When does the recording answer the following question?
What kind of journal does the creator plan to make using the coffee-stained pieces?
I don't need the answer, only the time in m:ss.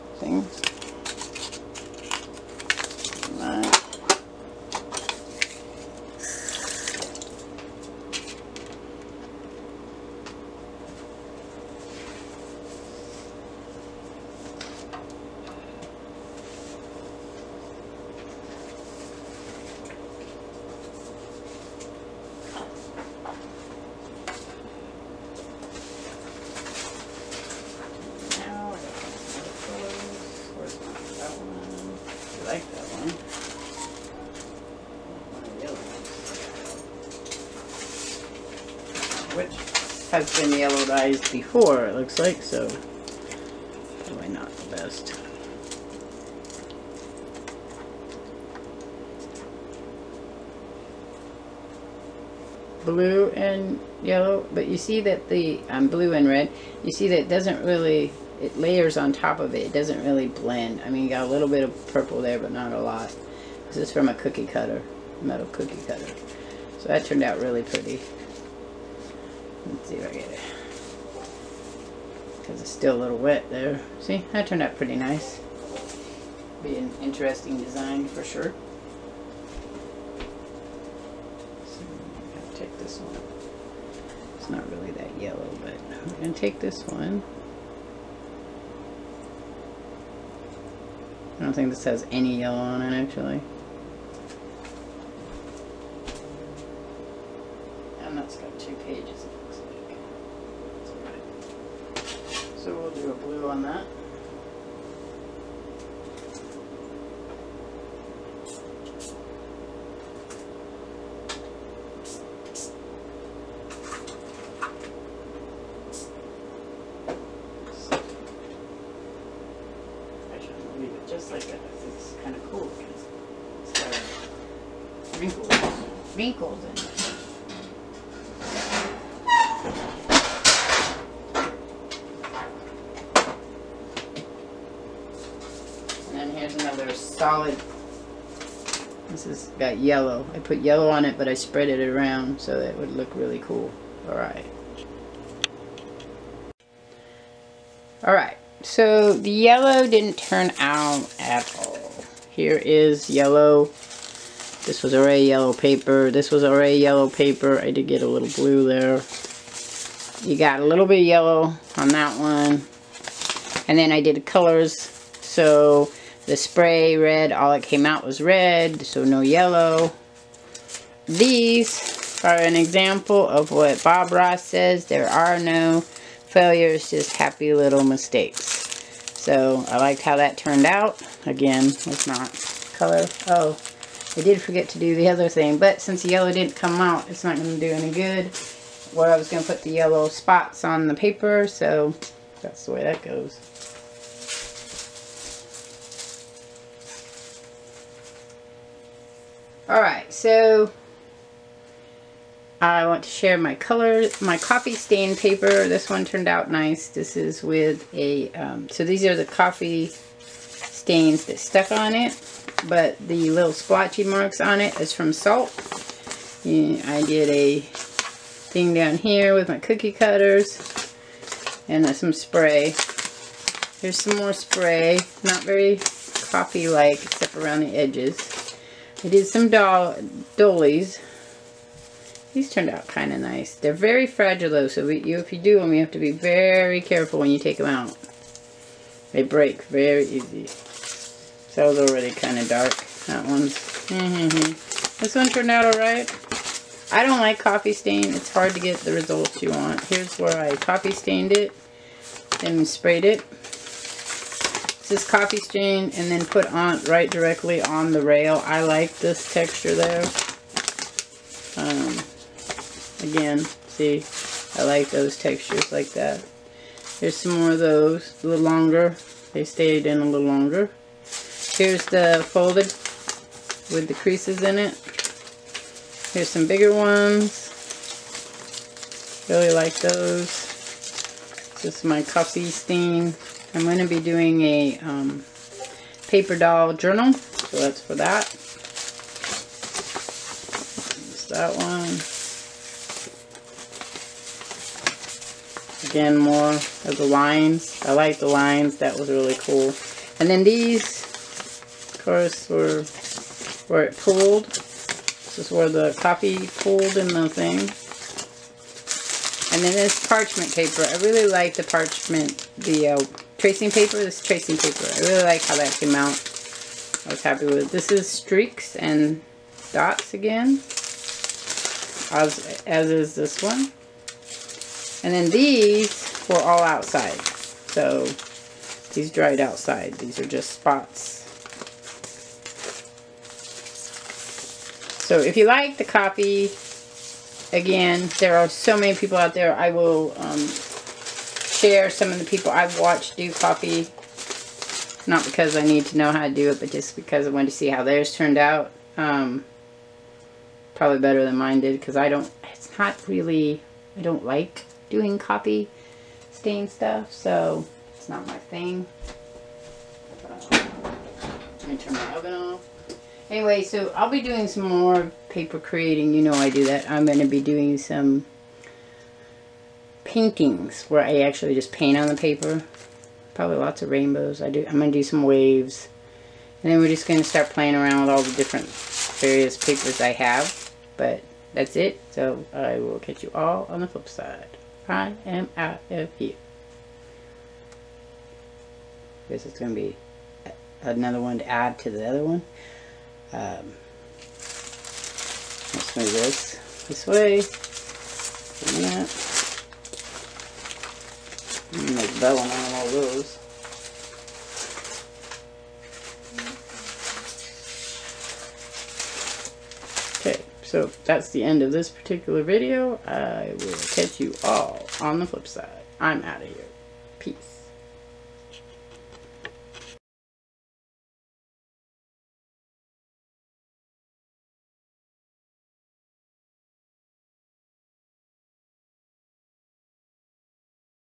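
4:46.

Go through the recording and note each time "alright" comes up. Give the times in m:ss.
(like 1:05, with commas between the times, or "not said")
2:24, 2:28, 3:19, 4:05.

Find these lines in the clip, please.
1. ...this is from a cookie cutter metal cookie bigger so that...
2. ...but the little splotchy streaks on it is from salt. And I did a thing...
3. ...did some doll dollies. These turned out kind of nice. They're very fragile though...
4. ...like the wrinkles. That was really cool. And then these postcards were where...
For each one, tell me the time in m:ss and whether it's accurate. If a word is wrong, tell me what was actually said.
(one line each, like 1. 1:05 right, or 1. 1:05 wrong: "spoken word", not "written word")
1. 1:03 wrong: "cutter", not "bigger"
2. 3:32 wrong: "marks", not "streaks"
3. 3:49 right
4. 4:57 wrong: "lines", not "wrinkles".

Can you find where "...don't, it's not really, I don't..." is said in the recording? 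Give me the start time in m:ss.
5:52.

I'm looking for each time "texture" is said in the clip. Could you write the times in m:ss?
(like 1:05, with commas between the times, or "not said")
4:19, 4:25.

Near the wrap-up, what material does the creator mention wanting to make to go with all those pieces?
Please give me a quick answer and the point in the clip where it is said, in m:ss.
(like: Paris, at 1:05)
vellum, at 6:42.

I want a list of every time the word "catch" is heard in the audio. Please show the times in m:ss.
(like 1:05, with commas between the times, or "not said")
6:22, 6:53.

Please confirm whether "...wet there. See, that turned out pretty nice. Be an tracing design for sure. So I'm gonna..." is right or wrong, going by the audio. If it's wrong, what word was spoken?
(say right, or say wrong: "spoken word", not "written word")
wrong: "interesting", not "tracing".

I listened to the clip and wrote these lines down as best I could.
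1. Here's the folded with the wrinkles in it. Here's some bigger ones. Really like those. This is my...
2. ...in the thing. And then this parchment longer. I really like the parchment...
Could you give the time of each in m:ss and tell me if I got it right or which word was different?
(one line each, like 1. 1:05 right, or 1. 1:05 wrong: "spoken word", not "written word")
1. 4:31 wrong: "creases", not "wrinkles"
2. 5:06 wrong: "paper", not "longer".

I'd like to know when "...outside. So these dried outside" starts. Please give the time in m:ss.
5:26.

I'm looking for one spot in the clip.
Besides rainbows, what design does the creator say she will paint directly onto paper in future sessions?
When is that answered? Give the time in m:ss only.
6:15.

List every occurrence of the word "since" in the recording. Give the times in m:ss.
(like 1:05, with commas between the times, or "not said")
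3:05.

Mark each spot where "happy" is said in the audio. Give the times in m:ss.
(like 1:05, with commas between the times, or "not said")
2:57, 5:17.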